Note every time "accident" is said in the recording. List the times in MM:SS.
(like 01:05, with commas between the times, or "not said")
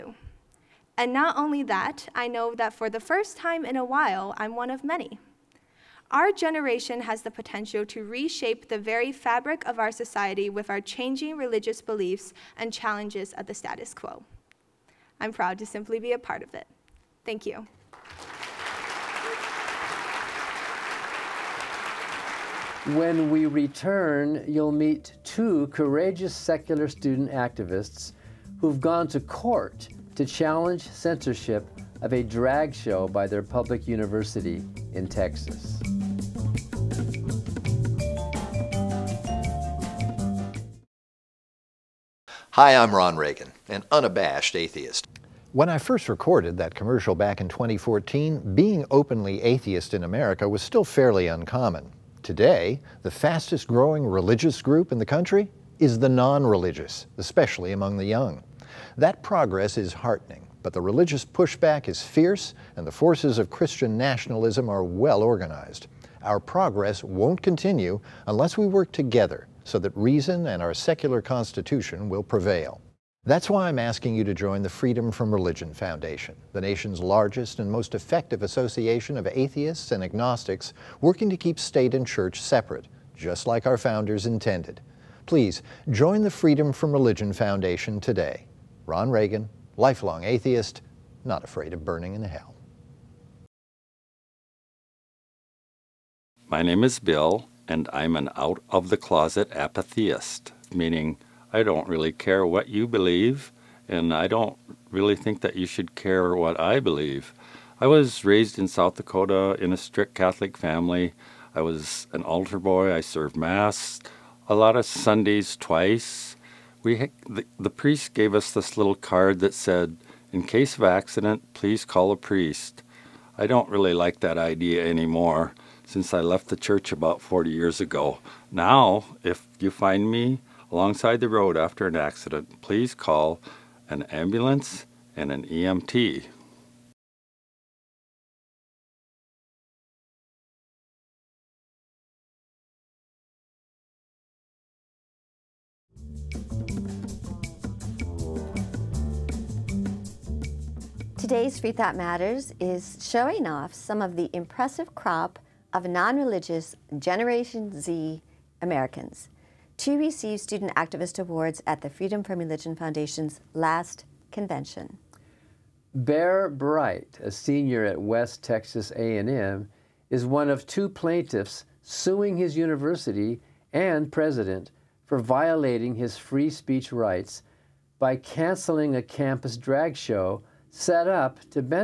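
02:00, 02:11.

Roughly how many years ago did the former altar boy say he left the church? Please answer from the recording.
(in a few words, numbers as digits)
40.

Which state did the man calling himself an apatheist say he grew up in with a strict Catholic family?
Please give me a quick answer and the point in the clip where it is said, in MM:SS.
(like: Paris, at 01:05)
South Dakota, at 01:48.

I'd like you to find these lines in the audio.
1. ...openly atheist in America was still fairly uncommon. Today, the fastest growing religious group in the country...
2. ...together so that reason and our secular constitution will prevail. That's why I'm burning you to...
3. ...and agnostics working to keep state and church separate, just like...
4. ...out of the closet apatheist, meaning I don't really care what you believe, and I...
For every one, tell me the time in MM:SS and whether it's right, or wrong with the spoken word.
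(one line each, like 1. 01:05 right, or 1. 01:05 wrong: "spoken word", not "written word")
1. 00:48 right
2. 01:08 wrong: "asking", not "burning"
3. 01:19 right
4. 01:38 right.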